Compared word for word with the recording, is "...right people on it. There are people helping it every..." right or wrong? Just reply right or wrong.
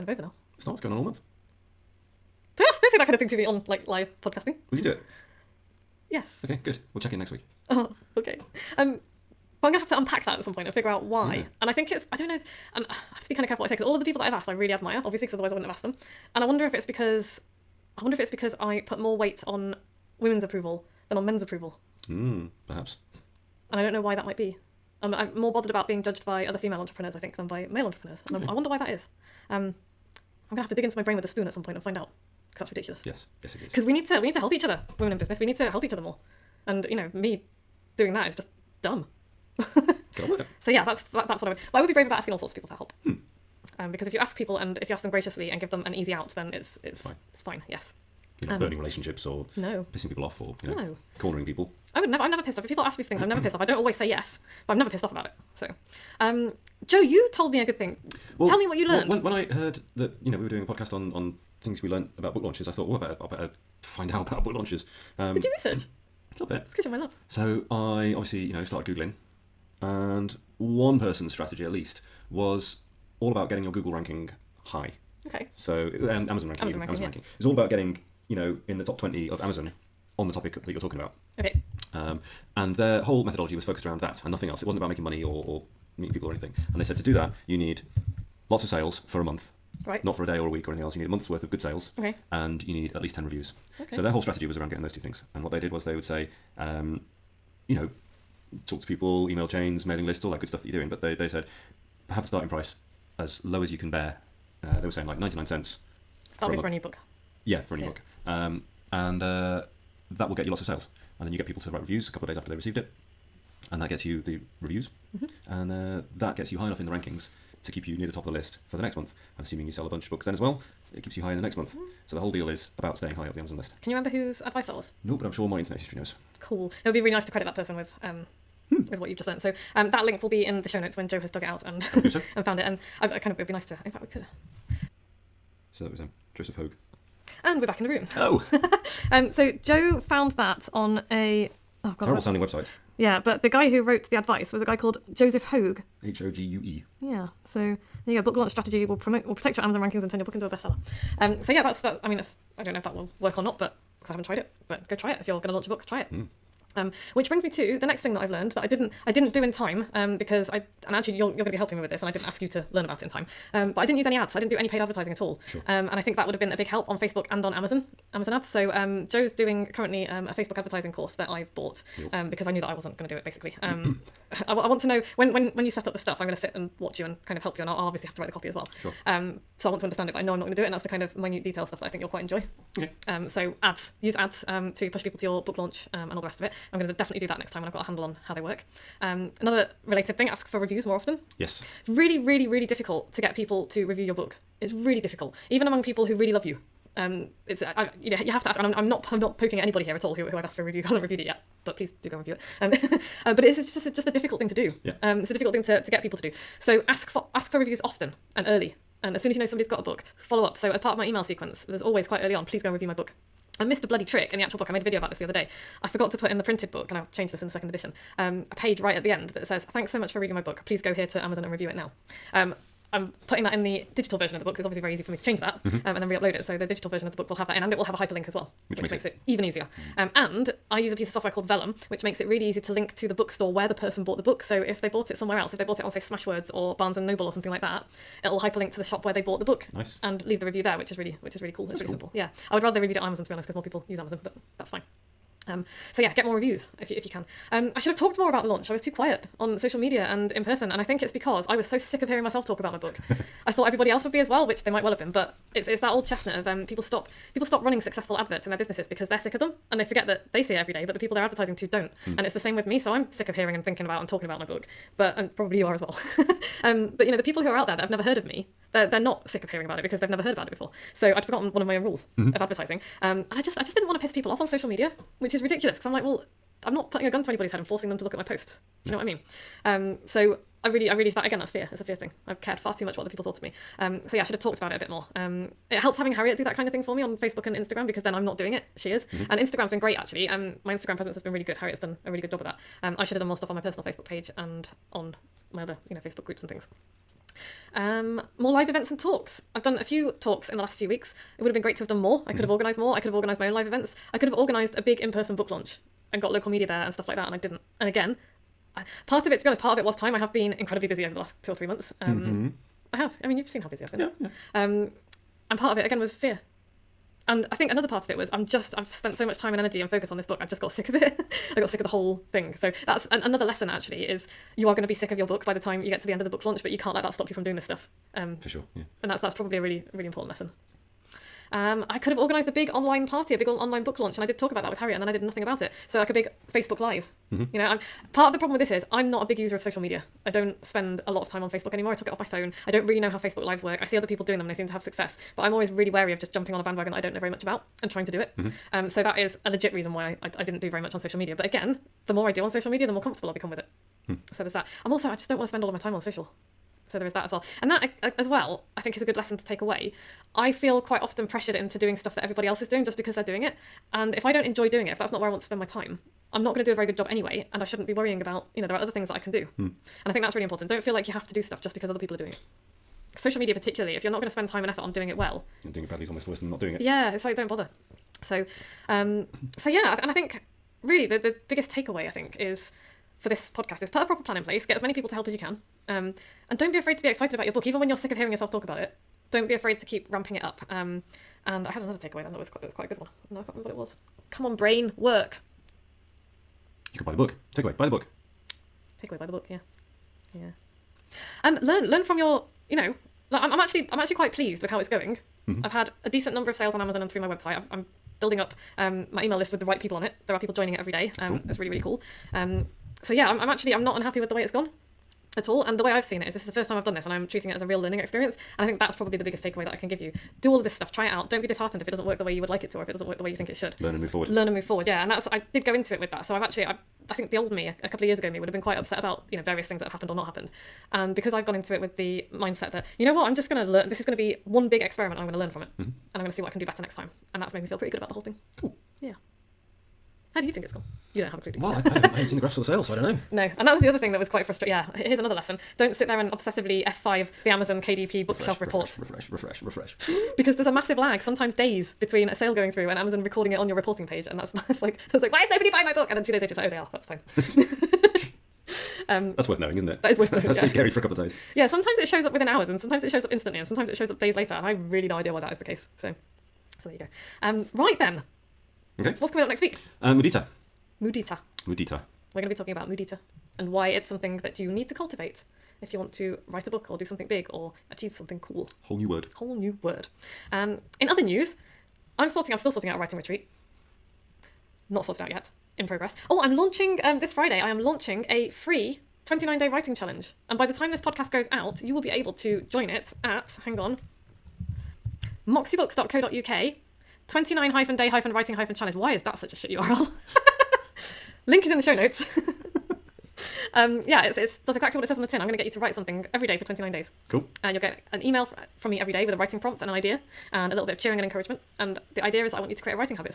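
wrong.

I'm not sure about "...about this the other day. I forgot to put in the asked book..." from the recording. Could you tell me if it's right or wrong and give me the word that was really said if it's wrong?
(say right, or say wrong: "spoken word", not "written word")
wrong: "printed", not "asked".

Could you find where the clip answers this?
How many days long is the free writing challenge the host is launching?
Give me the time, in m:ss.
8:09.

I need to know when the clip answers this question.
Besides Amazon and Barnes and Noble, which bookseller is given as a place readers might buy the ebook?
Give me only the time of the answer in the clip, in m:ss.
3:55.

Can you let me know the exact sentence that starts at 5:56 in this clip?
So there is that as well.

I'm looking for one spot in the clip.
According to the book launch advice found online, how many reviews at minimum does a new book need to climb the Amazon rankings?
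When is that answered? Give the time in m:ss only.
1:32.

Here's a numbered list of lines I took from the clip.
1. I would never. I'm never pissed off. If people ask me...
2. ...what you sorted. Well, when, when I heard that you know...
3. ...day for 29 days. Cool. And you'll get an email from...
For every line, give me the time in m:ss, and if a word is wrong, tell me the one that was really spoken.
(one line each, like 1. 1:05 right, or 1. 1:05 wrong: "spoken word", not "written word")
1. 0:51 right
2. 0:58 wrong: "learned", not "sorted"
3. 8:26 right.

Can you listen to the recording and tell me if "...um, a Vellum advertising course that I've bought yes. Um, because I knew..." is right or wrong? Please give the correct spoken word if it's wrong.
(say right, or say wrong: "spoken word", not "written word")
wrong: "Facebook", not "Vellum".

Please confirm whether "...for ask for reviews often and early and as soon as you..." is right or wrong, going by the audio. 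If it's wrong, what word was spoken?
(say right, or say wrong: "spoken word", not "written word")
right.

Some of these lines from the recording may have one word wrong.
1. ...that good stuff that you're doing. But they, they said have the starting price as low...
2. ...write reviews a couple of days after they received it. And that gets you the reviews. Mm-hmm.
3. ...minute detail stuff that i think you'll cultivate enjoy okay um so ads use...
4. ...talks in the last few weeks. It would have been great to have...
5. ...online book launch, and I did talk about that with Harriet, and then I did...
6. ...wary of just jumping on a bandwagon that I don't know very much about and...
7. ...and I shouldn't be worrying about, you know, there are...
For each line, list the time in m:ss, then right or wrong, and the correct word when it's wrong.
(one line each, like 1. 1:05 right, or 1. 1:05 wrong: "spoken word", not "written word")
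1. 1:40 right
2. 1:51 right
3. 3:01 wrong: "quite", not "cultivate"
4. 5:00 right
5. 5:33 right
6. 5:45 right
7. 6:07 right.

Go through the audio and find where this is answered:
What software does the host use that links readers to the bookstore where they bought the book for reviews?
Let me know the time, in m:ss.
3:51.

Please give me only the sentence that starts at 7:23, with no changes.
No, and that was the other thing that was quite frustrating.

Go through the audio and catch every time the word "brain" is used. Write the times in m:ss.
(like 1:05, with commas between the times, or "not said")
0:31, 6:34.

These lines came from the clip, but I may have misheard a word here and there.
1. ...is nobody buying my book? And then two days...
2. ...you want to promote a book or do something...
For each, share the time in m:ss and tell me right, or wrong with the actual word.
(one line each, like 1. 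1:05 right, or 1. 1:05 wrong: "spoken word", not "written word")
1. 7:35 right
2. 7:55 wrong: "write", not "promote".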